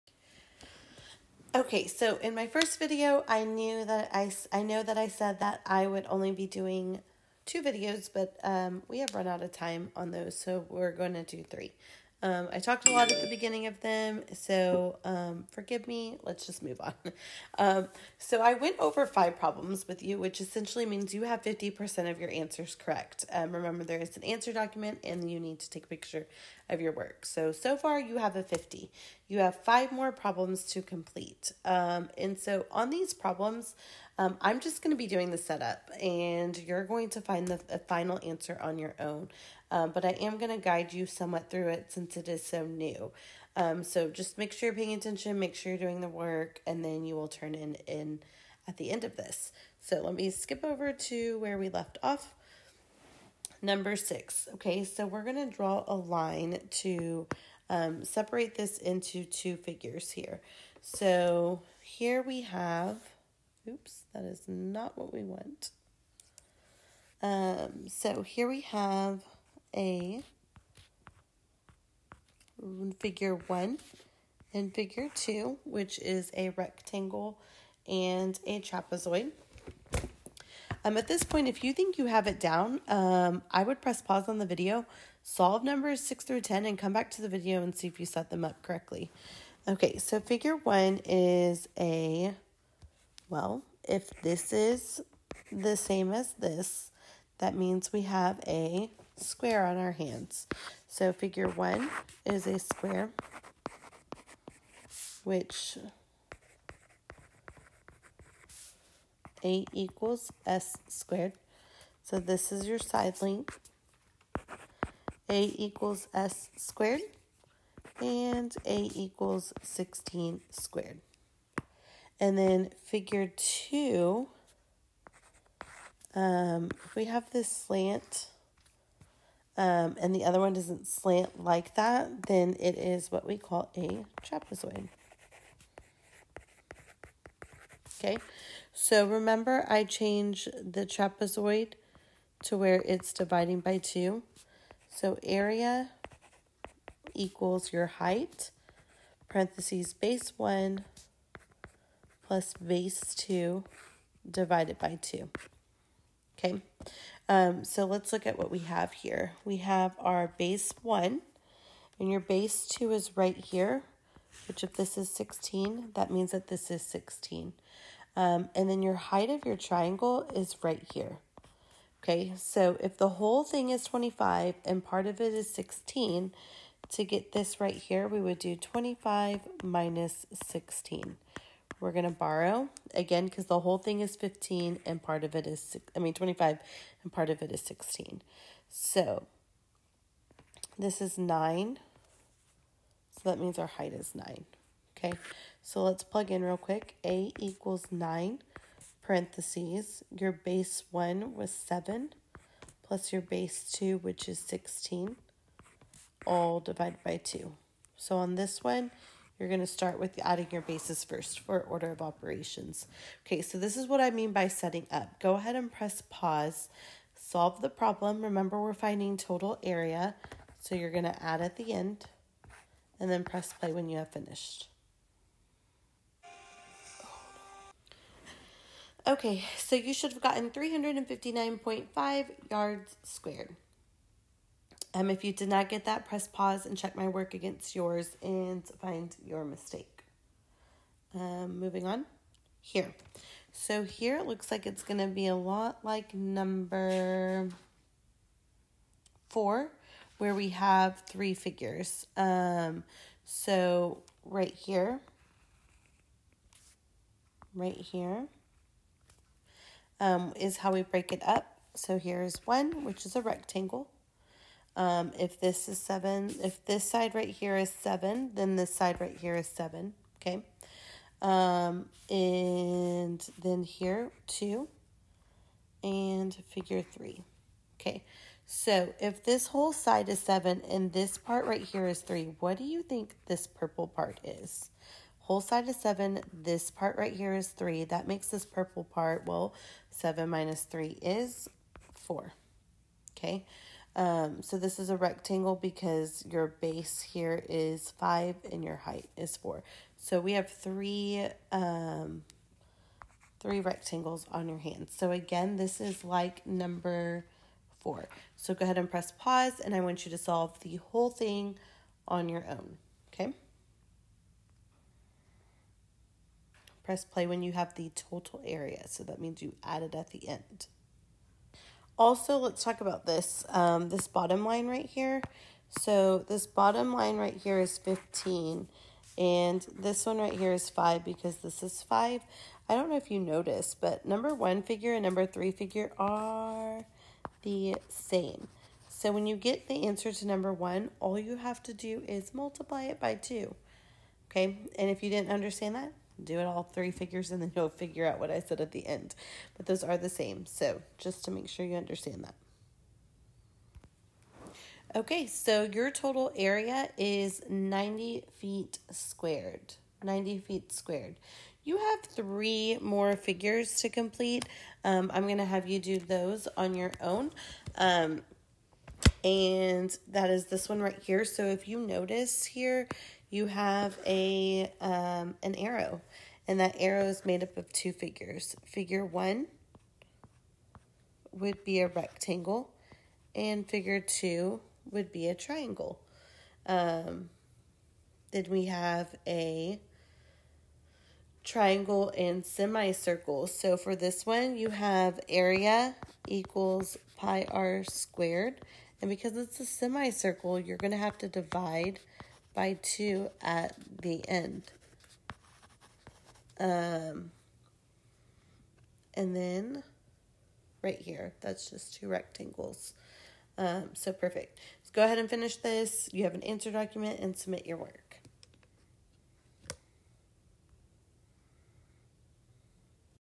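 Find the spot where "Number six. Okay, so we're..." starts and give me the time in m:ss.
0:53.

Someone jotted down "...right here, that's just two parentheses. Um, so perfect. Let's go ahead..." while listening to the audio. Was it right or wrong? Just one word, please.
wrong.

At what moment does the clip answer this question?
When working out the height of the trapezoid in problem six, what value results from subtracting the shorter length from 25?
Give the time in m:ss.
3:08.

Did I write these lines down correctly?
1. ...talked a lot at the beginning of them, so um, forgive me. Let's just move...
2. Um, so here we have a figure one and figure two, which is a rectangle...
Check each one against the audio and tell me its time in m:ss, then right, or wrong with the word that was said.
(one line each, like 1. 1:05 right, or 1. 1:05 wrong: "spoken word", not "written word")
1. 0:12 right
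2. 1:07 right.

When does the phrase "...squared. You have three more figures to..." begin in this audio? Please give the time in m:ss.
6:00.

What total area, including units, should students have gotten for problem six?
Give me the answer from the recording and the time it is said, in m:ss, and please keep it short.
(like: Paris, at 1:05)
359.5 yards squared, at 3:50.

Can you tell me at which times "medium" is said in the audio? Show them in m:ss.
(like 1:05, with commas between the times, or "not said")
not said.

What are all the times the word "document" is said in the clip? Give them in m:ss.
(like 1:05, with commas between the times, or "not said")
0:24, 6:56.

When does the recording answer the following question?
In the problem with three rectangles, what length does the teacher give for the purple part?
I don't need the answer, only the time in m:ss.
4:49.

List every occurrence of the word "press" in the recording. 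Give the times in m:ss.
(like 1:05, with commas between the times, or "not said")
1:23, 3:35, 3:43, 3:56, 5:08, 5:16.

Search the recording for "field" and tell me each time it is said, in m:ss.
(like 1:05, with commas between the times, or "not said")
not said.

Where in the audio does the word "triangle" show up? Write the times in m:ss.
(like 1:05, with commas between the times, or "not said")
2:49, 6:25, 6:31.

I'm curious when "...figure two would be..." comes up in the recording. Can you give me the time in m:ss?
6:23.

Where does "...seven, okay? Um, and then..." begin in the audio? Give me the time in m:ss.
4:29.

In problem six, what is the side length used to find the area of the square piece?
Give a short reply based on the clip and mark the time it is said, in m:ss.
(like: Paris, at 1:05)
16, at 1:58.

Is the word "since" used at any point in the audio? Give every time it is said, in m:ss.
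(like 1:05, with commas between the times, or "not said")
0:41.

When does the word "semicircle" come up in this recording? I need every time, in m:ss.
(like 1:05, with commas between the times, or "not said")
6:32, 6:39.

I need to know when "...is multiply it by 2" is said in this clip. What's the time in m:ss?
5:42.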